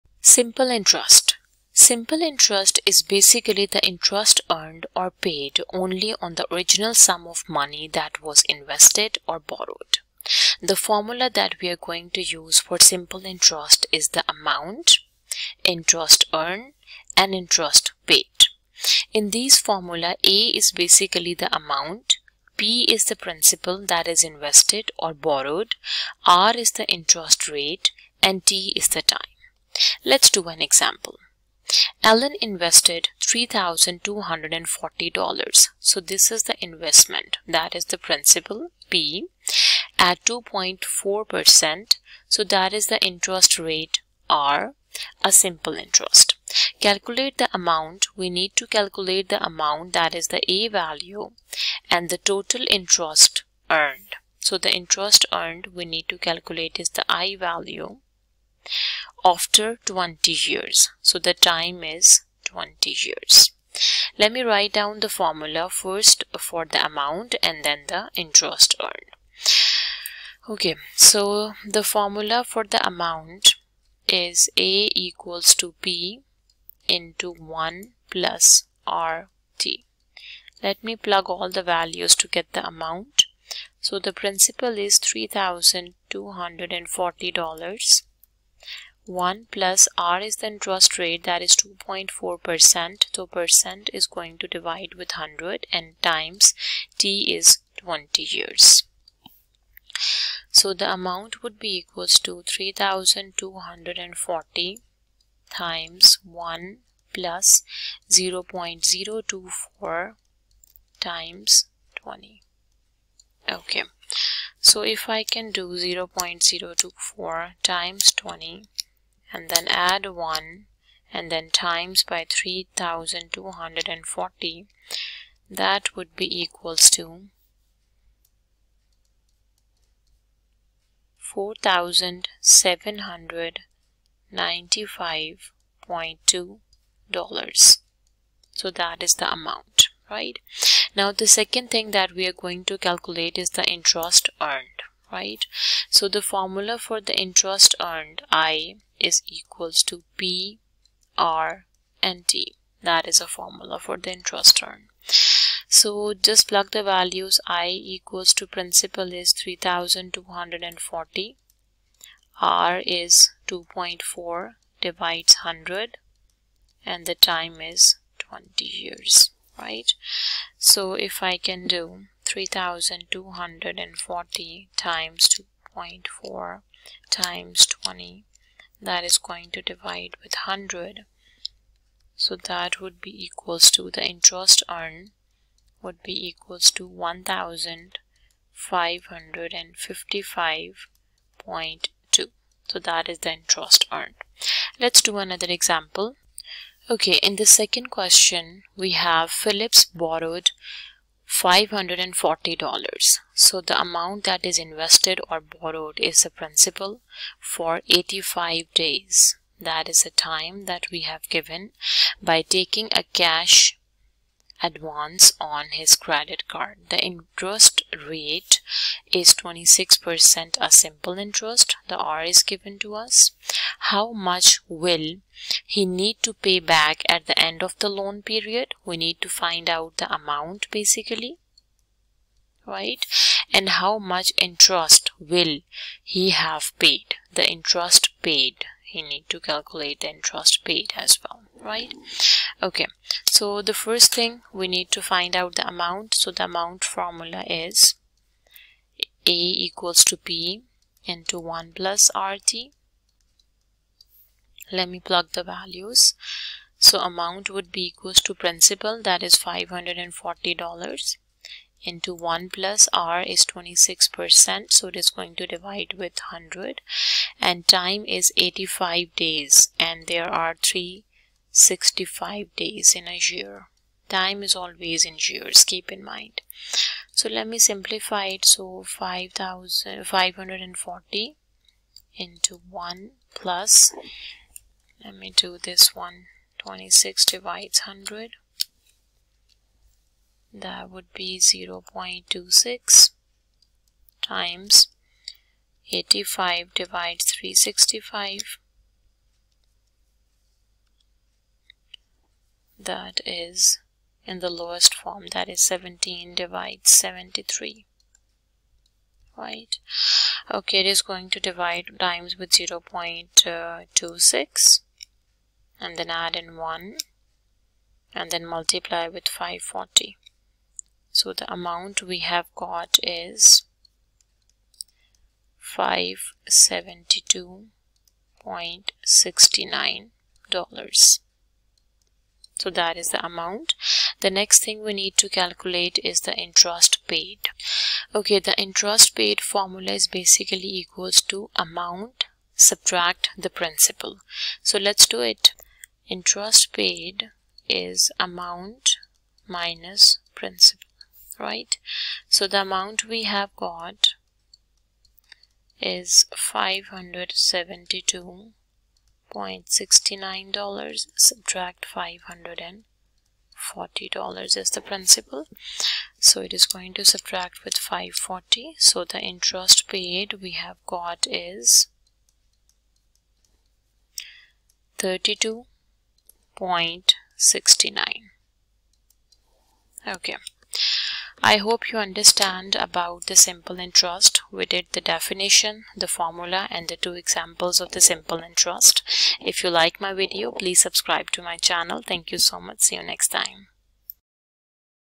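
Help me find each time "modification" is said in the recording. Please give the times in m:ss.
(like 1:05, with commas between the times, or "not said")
not said.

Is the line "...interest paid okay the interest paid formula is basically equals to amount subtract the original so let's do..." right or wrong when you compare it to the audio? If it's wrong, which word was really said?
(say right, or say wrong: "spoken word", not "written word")
wrong: "principal", not "original".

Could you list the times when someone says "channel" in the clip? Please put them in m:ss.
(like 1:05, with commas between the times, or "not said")
6:31.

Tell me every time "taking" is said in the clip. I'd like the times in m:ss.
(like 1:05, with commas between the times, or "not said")
3:32.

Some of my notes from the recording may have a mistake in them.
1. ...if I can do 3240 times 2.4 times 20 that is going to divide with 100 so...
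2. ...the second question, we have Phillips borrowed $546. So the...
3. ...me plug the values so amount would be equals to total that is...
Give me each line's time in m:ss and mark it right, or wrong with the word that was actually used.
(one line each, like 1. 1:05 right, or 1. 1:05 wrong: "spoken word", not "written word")
1. 2:50 right
2. 3:17 wrong: "540", not "546"
3. 4:14 wrong: "principal", not "total".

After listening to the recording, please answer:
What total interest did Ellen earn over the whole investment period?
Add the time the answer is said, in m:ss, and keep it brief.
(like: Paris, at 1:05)
1555.2, at 3:06.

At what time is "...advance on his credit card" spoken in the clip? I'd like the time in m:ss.
3:34.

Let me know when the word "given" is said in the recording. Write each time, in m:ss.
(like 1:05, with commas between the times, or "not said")
3:31, 3:42.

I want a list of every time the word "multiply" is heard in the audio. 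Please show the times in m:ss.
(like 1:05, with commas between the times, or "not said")
5:18.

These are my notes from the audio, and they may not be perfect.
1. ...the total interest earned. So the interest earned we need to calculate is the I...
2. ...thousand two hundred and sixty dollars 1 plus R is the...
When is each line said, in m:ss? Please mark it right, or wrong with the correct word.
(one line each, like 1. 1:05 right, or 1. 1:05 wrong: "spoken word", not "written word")
1. 0:52 right
2. 1:25 wrong: "forty", not "sixty".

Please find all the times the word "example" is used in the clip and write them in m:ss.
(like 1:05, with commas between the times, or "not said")
0:30, 3:15, 6:27.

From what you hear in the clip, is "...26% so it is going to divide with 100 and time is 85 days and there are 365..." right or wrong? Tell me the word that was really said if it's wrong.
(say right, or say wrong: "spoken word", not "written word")
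right.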